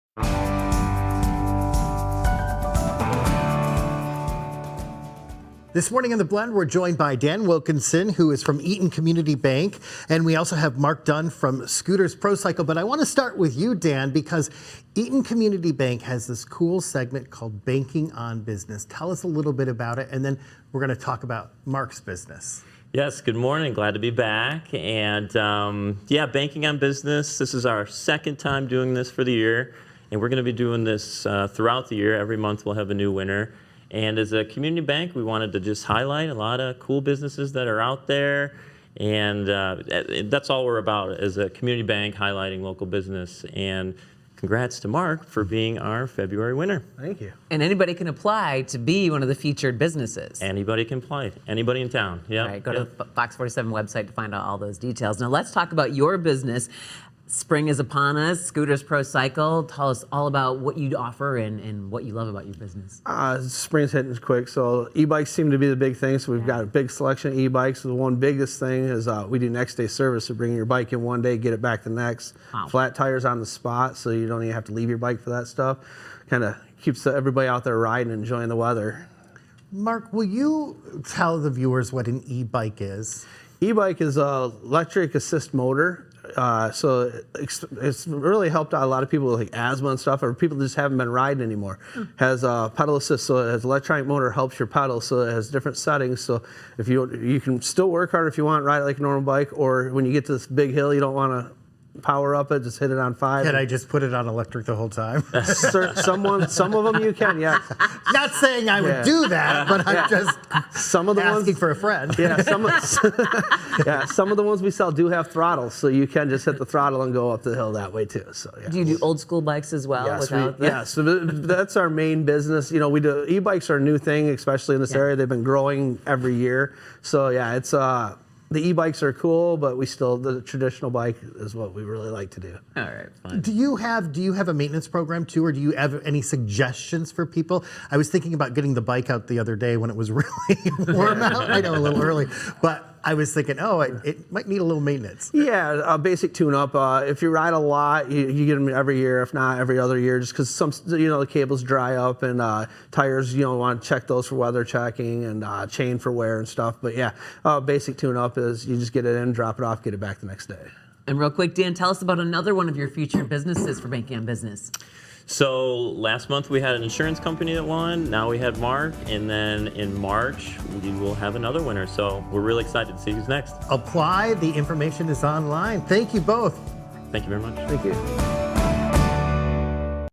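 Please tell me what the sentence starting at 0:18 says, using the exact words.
Tell us a little bit about it, and then we're going to talk about Mark's business.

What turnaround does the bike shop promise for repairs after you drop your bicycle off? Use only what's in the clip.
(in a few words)
Next day service.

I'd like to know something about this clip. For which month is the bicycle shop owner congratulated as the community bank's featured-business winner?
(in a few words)
February.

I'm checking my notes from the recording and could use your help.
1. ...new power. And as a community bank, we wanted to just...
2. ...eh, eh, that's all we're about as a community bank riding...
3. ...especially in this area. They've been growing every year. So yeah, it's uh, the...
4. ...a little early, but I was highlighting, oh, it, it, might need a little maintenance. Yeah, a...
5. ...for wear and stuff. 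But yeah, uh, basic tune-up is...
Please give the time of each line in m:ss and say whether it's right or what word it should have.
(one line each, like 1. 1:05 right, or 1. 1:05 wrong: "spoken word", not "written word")
1. 0:32 wrong: "winner", not "power"
2. 0:39 wrong: "highlighting", not "riding"
3. 2:04 right
4. 2:21 wrong: "thinking", not "highlighting"
5. 2:35 right.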